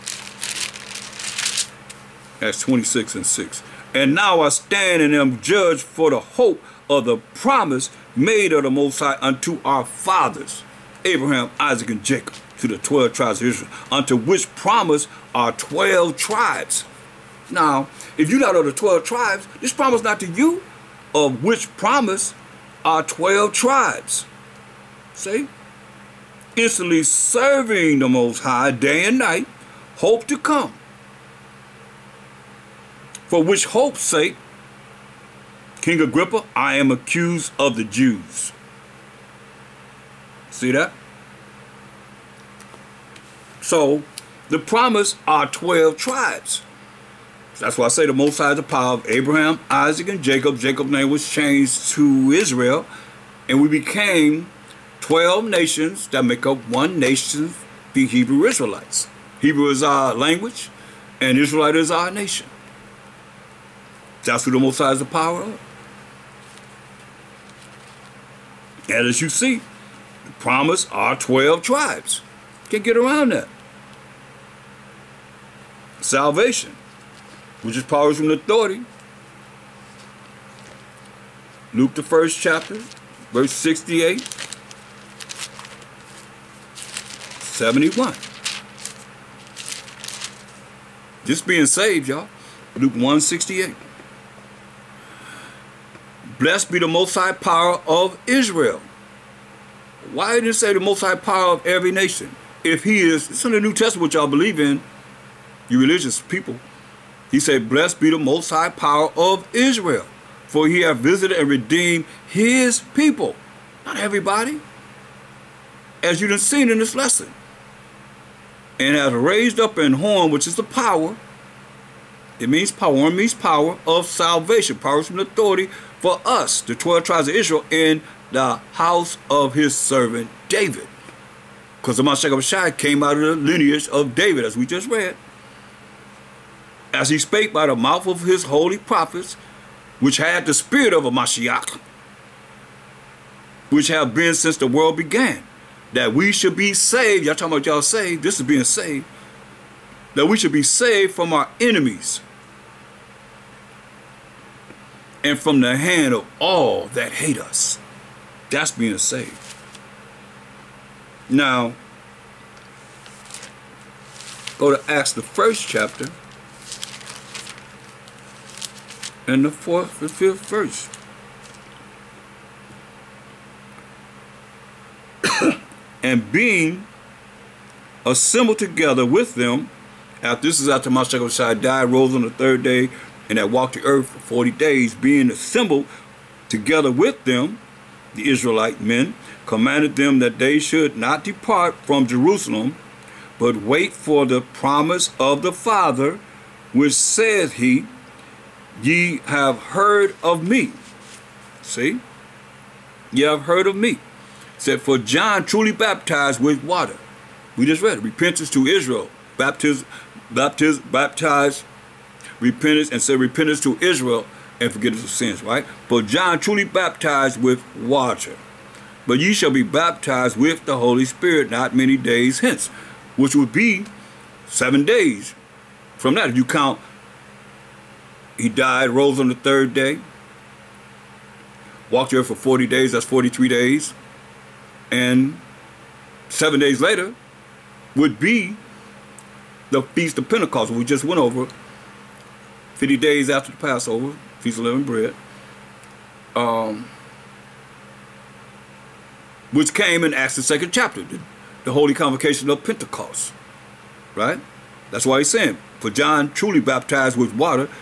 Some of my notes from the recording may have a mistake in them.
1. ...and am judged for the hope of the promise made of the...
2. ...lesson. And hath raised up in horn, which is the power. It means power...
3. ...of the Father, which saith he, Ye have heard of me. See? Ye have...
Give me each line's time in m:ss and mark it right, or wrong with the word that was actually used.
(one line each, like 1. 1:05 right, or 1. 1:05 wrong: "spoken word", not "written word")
1. 0:05 right
2. 1:56 right
3. 3:15 right.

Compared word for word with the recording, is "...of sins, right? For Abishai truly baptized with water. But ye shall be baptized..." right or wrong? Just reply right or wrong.
wrong.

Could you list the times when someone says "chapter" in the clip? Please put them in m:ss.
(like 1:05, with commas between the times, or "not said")
1:22, 2:45, 4:10.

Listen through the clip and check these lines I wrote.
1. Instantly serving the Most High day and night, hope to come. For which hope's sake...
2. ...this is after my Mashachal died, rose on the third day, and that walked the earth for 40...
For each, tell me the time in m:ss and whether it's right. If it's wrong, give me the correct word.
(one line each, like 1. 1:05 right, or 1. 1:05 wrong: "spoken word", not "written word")
1. 0:26 right
2. 3:00 right.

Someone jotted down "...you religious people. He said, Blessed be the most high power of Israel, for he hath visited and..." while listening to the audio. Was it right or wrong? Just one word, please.
right.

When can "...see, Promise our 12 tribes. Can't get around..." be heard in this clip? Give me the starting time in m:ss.
1:09.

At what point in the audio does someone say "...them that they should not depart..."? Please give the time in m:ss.
3:09.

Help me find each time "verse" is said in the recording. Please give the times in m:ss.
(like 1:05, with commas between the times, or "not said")
1:23, 2:50.